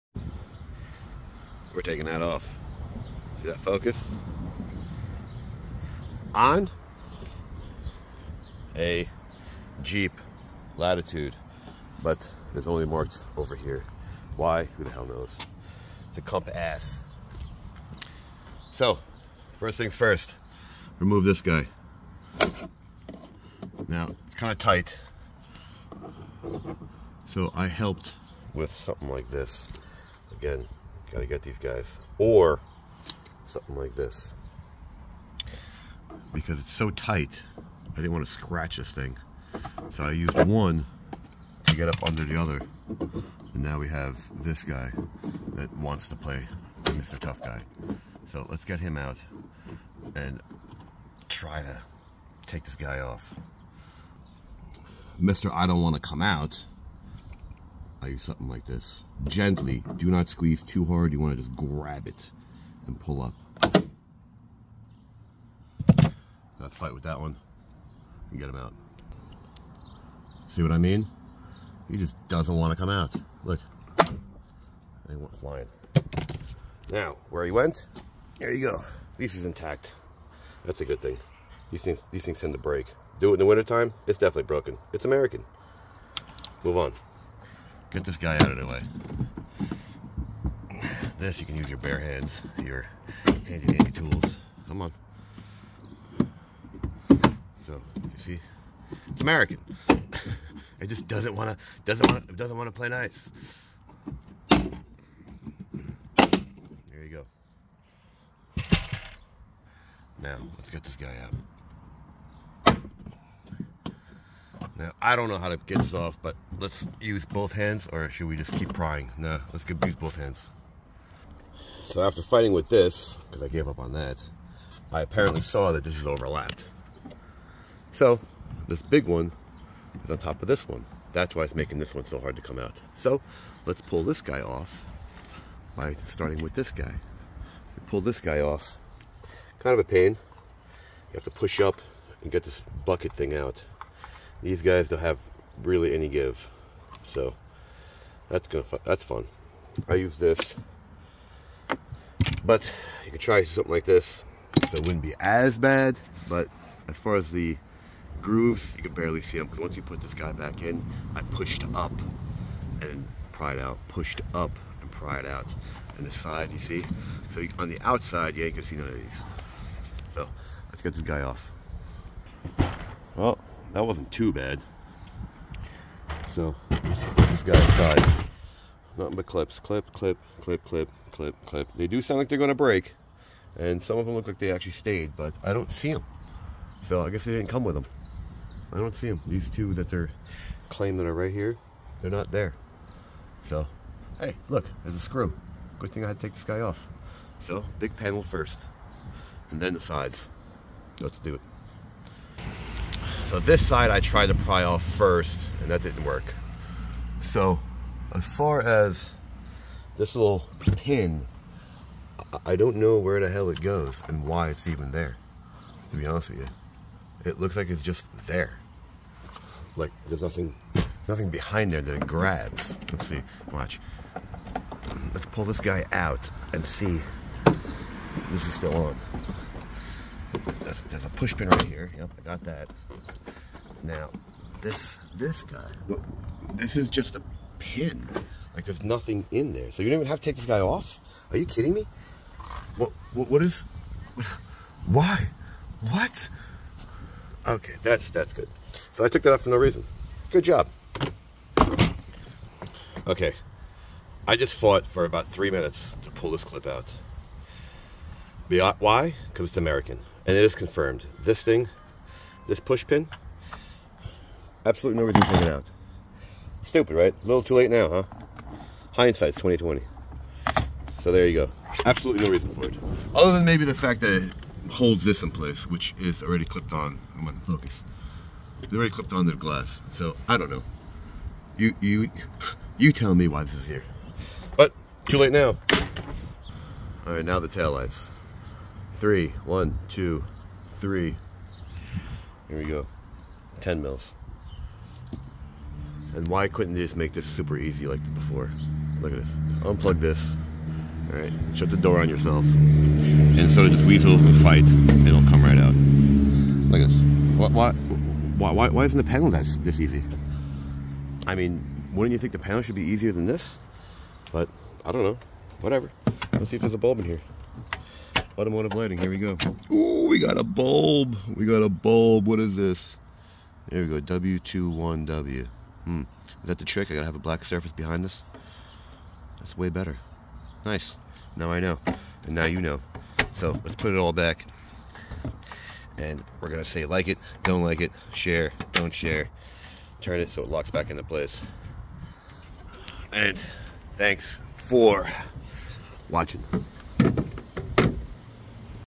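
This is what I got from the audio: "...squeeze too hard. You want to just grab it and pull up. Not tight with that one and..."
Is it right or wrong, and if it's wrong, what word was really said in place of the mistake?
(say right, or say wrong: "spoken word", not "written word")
wrong: "fight", not "tight".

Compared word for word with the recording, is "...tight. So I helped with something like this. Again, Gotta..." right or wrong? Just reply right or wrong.
right.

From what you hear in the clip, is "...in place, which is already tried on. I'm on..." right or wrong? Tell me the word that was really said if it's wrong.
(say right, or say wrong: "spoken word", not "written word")
wrong: "clipped", not "tried".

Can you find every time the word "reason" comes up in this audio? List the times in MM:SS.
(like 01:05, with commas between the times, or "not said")
04:09, 04:25, 04:32.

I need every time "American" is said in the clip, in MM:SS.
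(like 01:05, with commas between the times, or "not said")
01:25, 01:39, 04:19.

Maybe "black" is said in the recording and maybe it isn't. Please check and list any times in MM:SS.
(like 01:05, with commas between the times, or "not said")
05:27.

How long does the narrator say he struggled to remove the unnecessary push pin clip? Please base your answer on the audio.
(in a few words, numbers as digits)
about three minutes.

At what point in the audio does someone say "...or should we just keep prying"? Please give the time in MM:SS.
01:57.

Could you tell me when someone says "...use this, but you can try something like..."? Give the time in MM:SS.
02:29.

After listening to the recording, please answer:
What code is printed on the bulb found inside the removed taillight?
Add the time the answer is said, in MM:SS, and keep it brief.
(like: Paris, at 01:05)
W21W, at 05:24.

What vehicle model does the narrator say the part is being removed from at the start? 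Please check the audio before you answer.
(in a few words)
Jeep Latitude.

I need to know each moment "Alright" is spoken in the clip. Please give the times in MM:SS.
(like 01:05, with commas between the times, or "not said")
04:47.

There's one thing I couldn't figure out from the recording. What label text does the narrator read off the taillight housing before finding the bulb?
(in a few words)
Automotive lighting.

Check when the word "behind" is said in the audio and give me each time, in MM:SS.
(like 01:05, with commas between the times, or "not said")
03:41, 05:27.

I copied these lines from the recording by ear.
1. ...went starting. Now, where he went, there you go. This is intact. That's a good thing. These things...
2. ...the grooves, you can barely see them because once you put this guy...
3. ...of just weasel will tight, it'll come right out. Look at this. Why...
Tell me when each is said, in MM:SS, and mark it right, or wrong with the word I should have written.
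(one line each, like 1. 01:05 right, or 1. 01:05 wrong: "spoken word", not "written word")
1. 01:15 wrong: "flying", not "starting"
2. 02:37 right
3. 05:03 wrong: "fight", not "tight".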